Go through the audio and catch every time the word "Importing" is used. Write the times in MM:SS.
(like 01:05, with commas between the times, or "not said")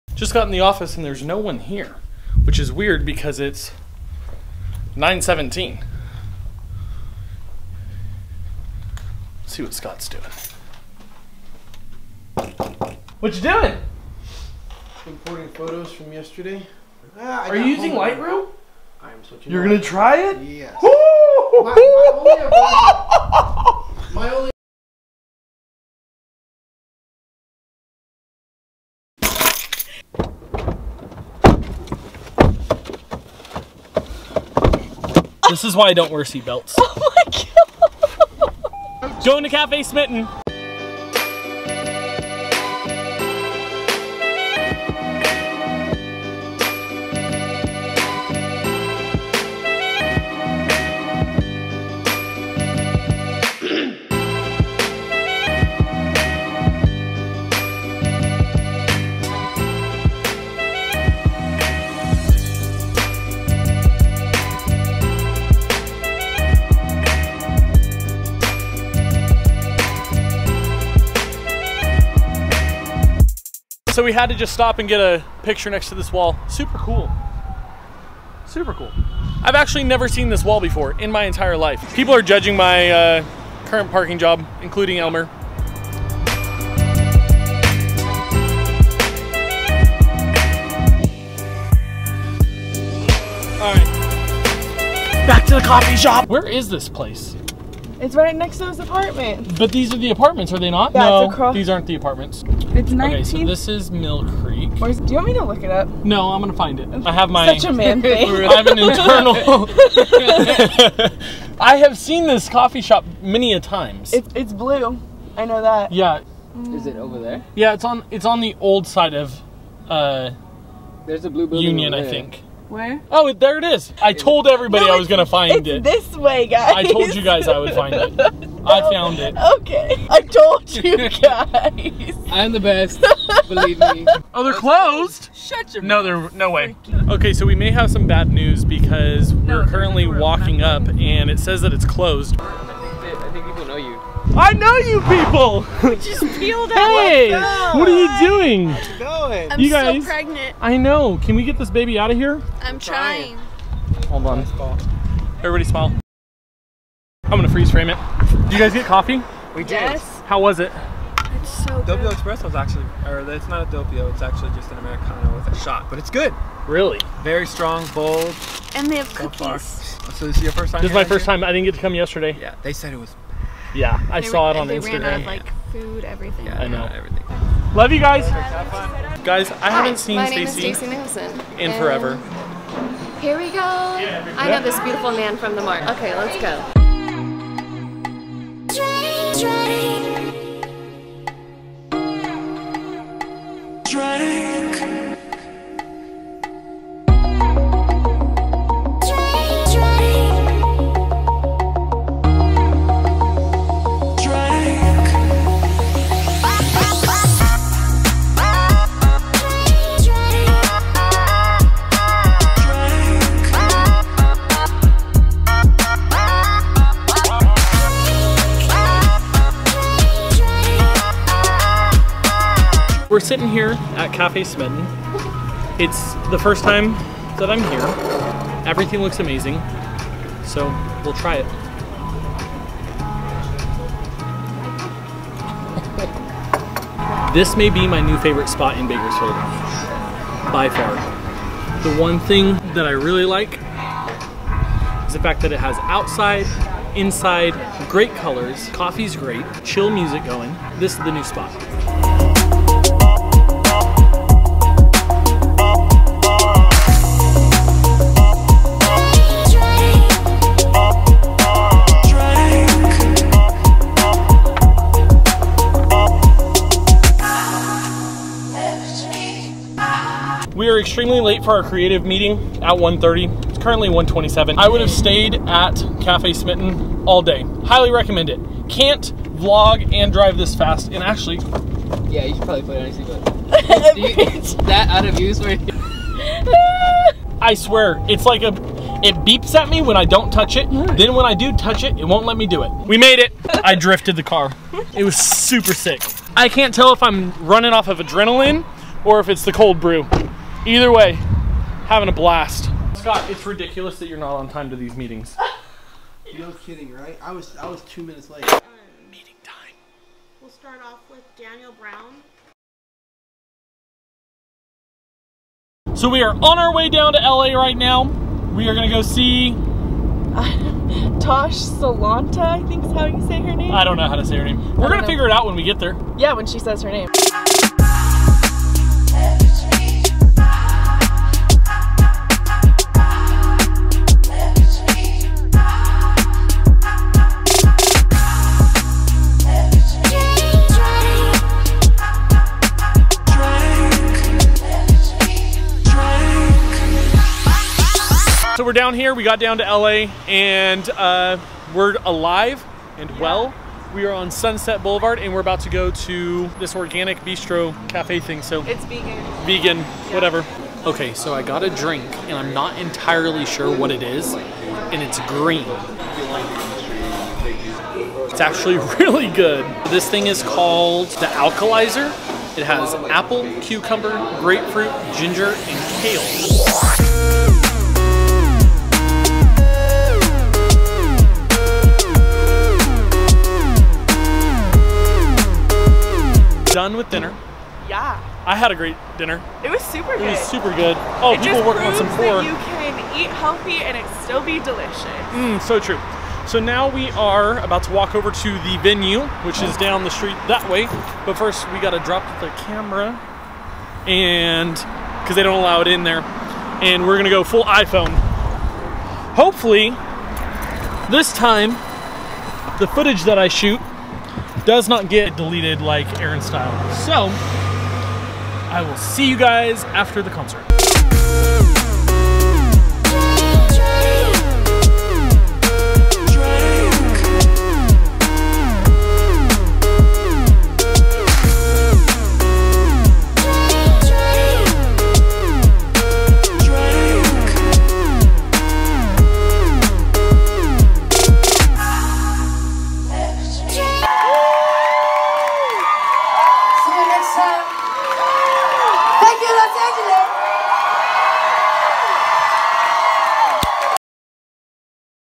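00:15.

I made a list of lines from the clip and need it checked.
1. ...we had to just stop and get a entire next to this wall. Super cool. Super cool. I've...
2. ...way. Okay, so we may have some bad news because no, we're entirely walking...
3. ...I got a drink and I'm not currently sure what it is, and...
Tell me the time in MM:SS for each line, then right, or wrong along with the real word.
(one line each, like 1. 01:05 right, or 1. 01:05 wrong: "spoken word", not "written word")
1. 01:14 wrong: "picture", not "entire"
2. 02:16 wrong: "currently", not "entirely"
3. 06:01 wrong: "entirely", not "currently".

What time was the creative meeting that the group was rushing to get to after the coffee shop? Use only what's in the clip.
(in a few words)
1:30.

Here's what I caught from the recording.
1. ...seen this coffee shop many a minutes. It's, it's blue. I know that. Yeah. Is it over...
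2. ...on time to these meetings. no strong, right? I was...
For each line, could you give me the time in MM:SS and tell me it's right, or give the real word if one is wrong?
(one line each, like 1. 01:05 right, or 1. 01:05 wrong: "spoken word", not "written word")
1. 01:51 wrong: "times", not "minutes"
2. 05:04 wrong: "kidding", not "strong".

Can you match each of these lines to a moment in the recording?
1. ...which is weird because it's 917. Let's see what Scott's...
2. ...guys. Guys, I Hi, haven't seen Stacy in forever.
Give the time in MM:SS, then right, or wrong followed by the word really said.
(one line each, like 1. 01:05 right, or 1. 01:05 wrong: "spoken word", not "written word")
1. 00:02 right
2. 02:57 right.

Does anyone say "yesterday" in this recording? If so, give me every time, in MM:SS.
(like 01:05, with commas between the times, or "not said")
00:16, 02:51.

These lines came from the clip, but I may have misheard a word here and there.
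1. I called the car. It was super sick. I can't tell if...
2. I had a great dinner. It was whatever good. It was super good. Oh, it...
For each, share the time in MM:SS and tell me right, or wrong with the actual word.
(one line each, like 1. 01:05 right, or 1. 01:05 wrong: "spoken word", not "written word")
1. 04:53 wrong: "drifted", not "called"
2. 06:28 wrong: "super", not "whatever".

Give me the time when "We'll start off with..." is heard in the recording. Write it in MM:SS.
05:10.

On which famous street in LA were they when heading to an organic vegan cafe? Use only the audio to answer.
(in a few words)
Sunset Boulevard.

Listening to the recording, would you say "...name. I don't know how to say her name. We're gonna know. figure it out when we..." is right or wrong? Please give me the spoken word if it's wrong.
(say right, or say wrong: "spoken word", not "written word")
right.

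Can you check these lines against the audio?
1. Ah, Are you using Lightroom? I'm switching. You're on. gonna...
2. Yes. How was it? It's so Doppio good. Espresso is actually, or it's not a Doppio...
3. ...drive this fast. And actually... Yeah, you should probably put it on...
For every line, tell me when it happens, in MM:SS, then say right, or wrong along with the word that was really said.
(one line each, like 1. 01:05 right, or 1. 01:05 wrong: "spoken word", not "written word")
1. 00:17 right
2. 02:39 right
3. 04:40 right.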